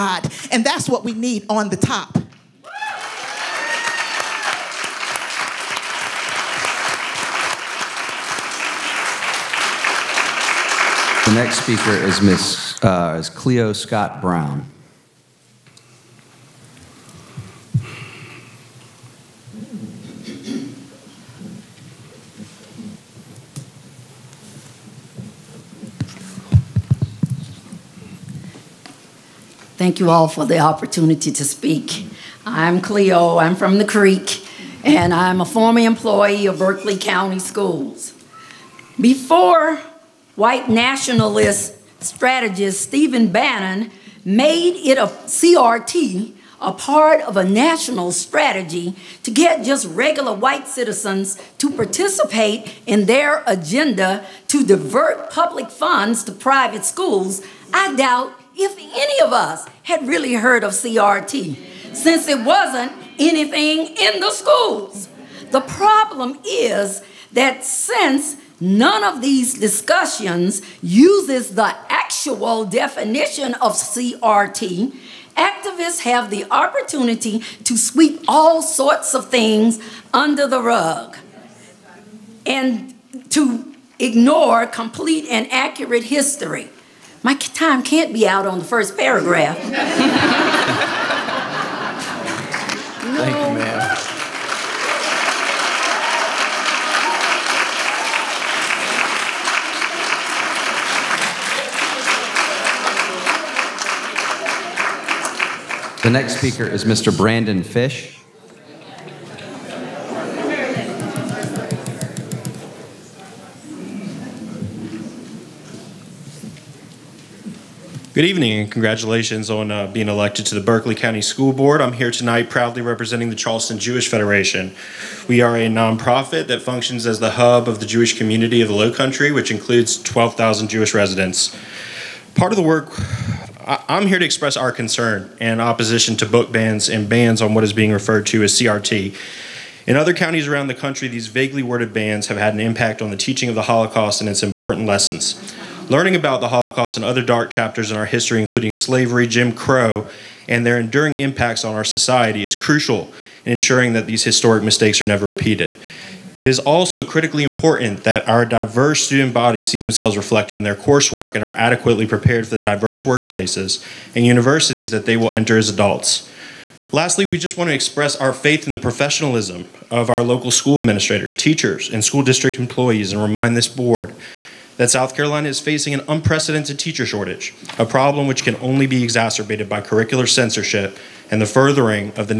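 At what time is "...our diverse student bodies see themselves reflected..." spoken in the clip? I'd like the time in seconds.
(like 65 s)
158 s.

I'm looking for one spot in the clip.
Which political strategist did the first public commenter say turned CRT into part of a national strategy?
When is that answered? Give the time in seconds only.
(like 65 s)
42 s.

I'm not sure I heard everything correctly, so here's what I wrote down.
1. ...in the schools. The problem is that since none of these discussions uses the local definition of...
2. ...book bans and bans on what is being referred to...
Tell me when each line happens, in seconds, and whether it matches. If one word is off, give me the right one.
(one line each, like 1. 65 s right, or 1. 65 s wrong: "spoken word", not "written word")
1. 63 s wrong: "actual", not "local"
2. 136 s right.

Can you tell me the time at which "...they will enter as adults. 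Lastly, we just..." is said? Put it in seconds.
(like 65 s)
165 s.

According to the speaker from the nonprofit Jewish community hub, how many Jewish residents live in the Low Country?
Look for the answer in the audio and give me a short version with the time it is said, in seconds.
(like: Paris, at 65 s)
12,000, at 130 s.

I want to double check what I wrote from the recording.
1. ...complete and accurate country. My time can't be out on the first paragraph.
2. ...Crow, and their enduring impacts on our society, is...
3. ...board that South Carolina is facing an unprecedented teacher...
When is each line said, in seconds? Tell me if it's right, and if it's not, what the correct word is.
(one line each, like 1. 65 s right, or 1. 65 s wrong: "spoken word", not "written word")
1. 84 s wrong: "history", not "country"
2. 149 s right
3. 173 s right.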